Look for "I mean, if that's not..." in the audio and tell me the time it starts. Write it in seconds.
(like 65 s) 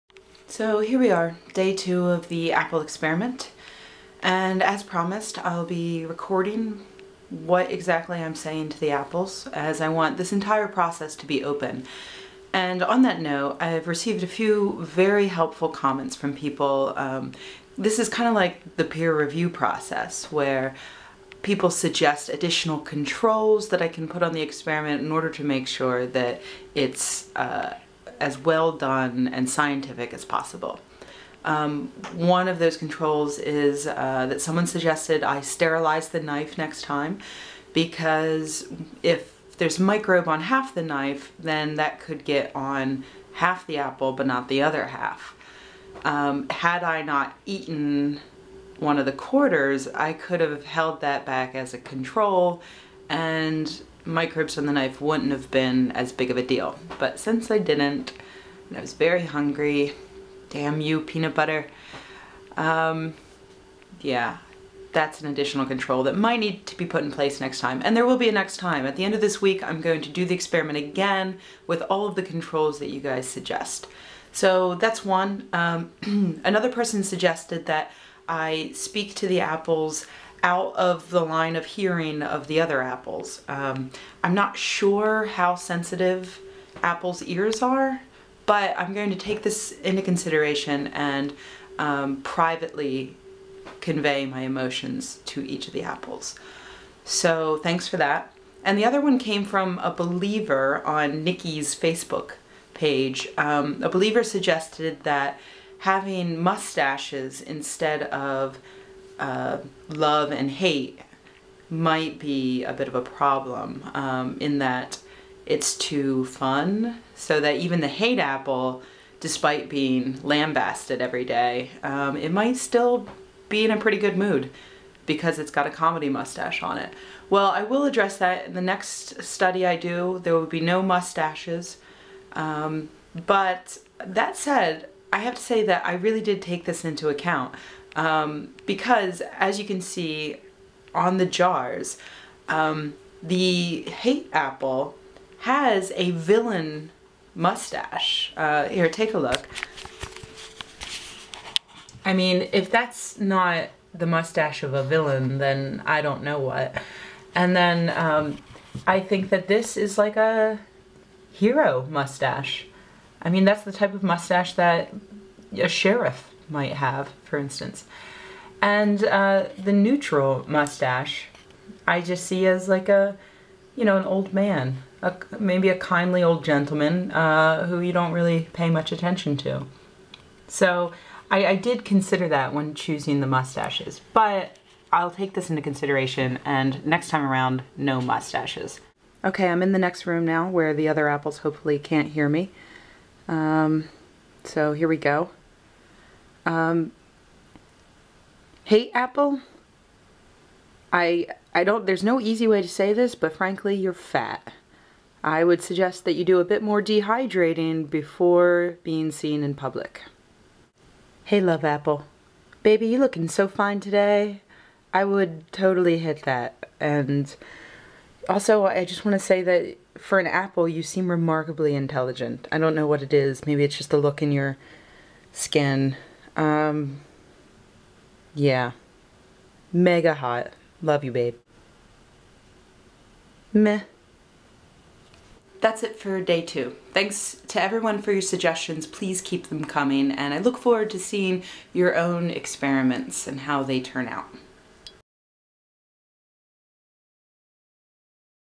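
152 s.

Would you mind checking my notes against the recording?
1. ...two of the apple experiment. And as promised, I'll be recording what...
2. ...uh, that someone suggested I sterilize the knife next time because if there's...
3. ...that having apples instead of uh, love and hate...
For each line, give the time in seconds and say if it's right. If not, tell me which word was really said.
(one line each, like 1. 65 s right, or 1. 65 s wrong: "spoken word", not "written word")
1. 1 s right
2. 33 s right
3. 105 s wrong: "mustaches", not "apples".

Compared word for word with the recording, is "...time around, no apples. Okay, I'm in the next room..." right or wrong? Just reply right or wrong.
wrong.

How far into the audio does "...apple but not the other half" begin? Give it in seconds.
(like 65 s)
43 s.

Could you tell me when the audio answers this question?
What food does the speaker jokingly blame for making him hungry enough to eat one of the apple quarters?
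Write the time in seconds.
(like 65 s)
61 s.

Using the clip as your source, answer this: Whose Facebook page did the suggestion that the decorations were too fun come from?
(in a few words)
Nikki's.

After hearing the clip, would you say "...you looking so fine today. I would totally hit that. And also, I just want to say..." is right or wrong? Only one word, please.
right.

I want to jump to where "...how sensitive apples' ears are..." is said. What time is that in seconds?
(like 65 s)
85 s.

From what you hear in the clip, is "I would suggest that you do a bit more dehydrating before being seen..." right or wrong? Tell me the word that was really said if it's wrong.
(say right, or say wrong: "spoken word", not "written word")
right.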